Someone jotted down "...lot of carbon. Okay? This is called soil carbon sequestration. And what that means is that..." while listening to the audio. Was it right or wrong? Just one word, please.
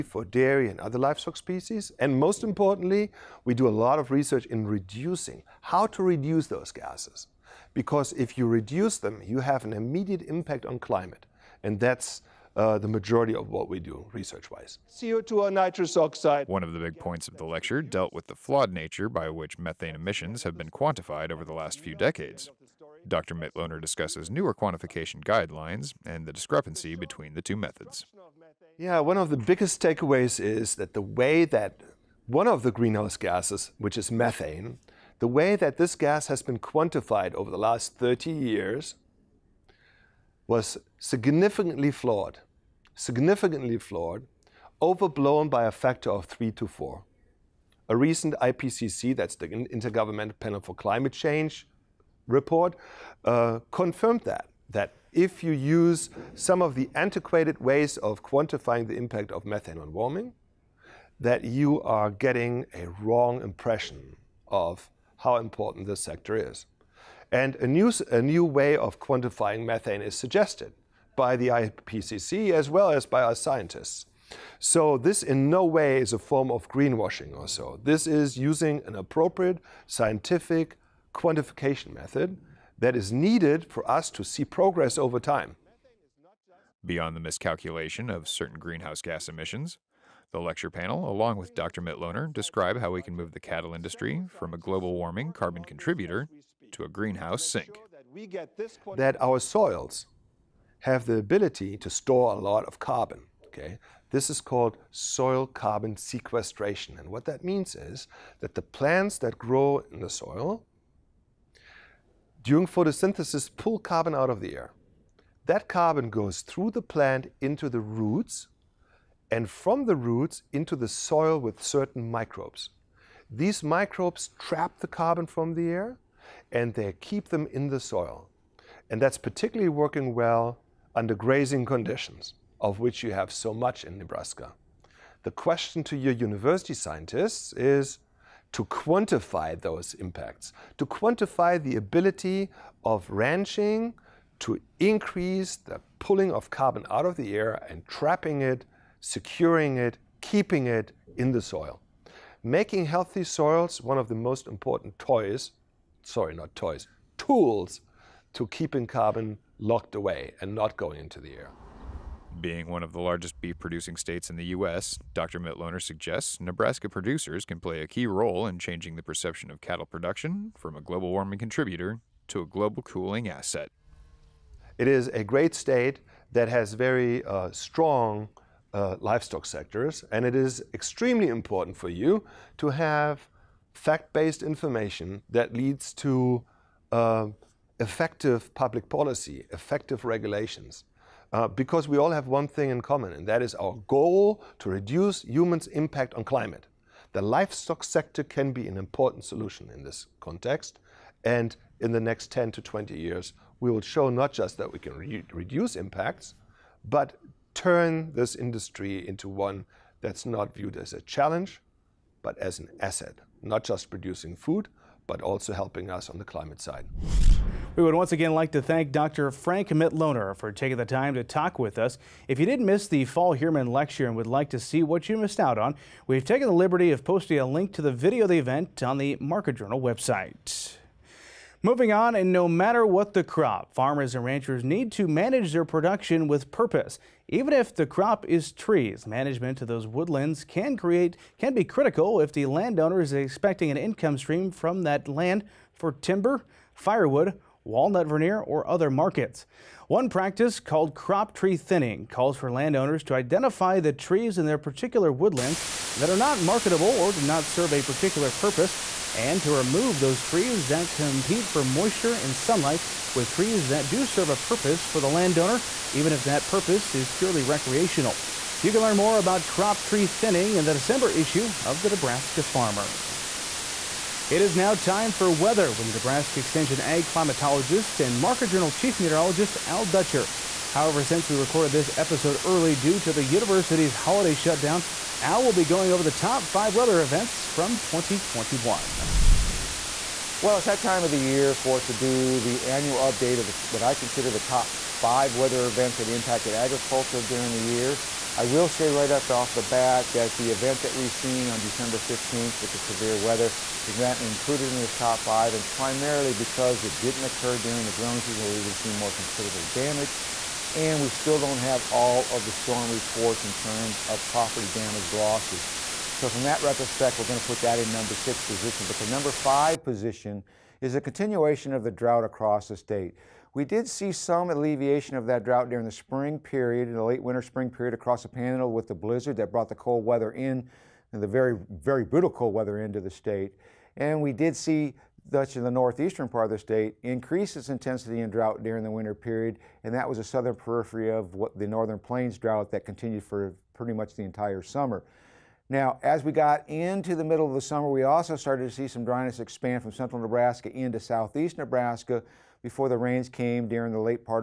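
right.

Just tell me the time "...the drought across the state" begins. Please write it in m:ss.
5:21.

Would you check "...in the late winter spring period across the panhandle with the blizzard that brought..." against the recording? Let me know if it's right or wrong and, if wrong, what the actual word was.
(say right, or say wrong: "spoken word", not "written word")
right.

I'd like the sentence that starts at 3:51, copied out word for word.
Moving on, and no matter what the crop, farmers and ranchers need to manage their production with purpose.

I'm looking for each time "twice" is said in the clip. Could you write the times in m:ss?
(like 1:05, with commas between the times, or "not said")
not said.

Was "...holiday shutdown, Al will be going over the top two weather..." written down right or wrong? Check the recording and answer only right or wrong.
wrong.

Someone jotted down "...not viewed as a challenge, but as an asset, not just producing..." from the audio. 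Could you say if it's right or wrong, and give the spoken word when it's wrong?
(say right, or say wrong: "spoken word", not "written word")
right.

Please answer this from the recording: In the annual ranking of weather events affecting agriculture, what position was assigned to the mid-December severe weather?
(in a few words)
number 6.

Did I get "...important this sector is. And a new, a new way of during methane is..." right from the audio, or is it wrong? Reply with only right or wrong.
wrong.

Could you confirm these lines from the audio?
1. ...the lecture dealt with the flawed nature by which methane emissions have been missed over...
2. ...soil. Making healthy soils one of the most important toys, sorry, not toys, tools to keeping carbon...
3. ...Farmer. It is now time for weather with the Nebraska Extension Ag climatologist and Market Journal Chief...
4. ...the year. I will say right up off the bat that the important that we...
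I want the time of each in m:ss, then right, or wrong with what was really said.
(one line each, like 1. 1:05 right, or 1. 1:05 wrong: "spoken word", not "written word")
1. 0:17 wrong: "quantified", not "missed"
2. 2:31 right
3. 4:32 right
4. 4:57 wrong: "event", not "important".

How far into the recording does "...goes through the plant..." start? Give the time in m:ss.
1:56.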